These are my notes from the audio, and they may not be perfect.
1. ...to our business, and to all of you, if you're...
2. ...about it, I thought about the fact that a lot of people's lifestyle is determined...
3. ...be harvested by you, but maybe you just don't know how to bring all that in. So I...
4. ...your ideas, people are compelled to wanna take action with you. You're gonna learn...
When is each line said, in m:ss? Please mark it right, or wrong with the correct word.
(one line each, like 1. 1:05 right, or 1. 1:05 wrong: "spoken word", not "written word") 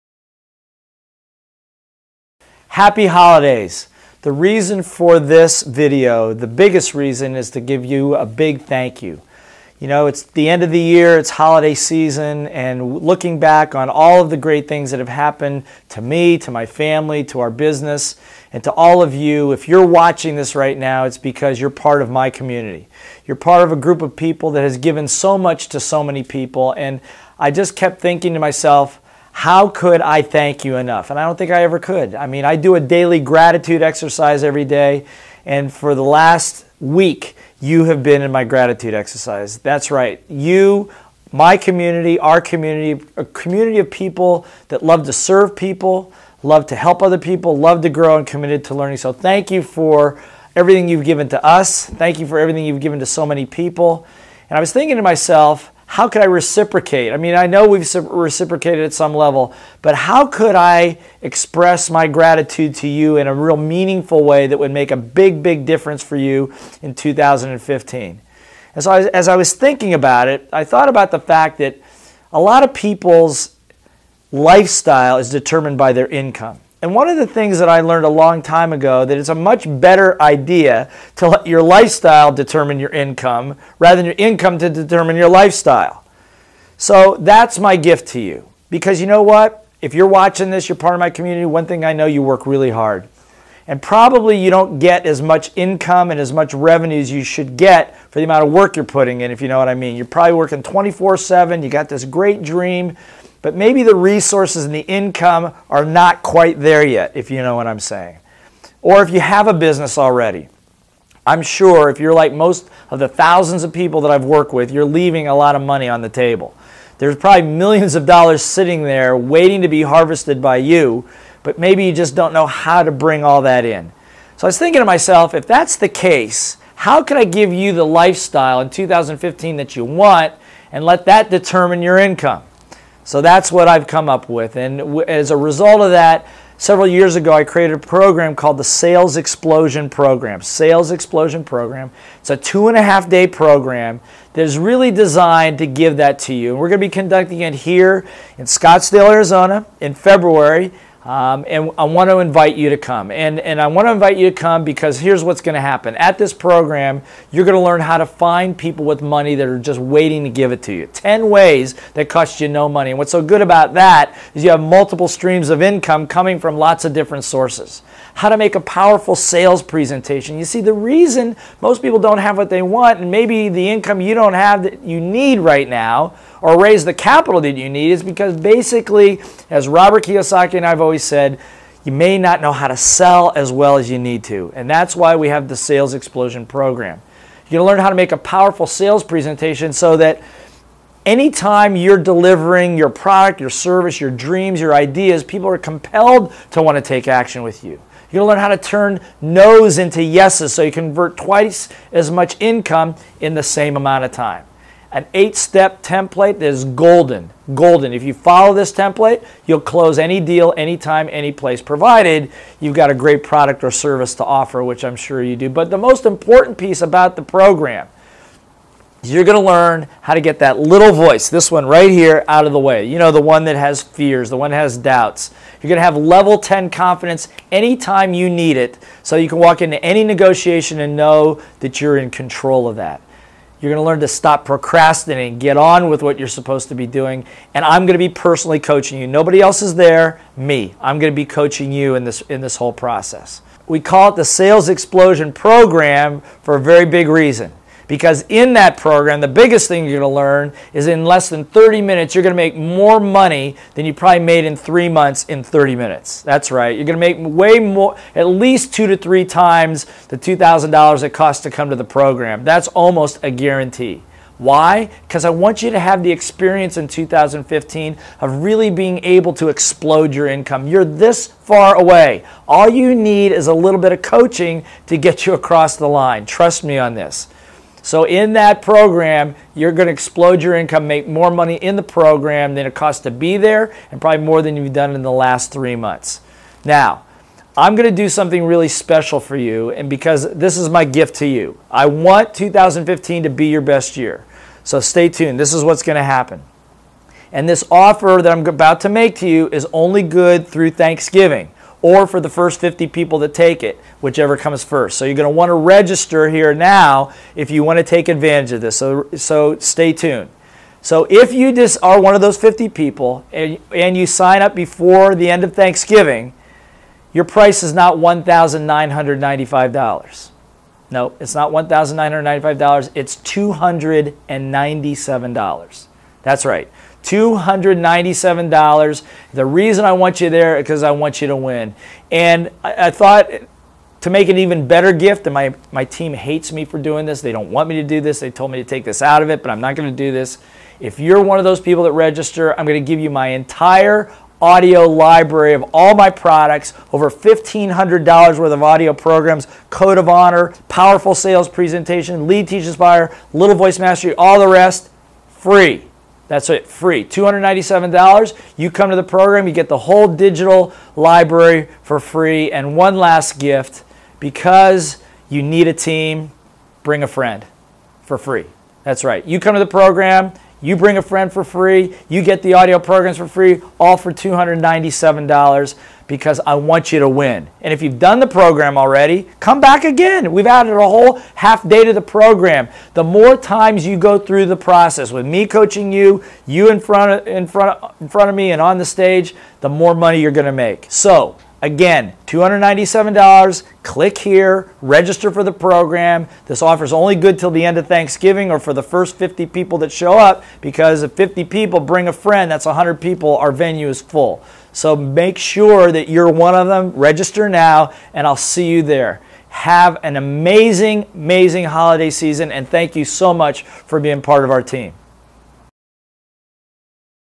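1. 0:17 right
2. 1:09 right
3. 1:59 right
4. 3:14 right.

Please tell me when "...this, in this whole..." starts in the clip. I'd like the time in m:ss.
4:02.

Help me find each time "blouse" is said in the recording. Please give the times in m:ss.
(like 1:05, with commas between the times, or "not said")
not said.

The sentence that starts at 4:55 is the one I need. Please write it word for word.
This is what's going to happen.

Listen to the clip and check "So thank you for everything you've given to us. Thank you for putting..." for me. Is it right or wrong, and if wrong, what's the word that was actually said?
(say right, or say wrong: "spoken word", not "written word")
wrong: "everything", not "putting".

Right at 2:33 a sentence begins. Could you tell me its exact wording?
And, and I want to invite you to come because here's what's going to happen.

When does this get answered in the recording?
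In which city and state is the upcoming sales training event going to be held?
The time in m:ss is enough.
2:28.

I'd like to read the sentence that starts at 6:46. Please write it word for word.
Register now, and I'll see you there.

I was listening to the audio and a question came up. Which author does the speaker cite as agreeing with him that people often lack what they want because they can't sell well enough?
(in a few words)
Robert Kiyosaki.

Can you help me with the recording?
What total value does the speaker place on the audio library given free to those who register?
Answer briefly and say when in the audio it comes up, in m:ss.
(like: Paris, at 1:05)
over $1,500, at 5:46.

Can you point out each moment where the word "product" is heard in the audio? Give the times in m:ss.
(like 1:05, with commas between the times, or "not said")
3:12, 3:33, 5:46.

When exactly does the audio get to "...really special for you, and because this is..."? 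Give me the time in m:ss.
4:48.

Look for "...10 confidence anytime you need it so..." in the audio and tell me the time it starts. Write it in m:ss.
3:46.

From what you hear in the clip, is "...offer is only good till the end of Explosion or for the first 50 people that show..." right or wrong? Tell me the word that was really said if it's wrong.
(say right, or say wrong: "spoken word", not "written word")
wrong: "Thanksgiving", not "Explosion".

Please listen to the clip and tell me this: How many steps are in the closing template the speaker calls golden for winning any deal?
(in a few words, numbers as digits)
8.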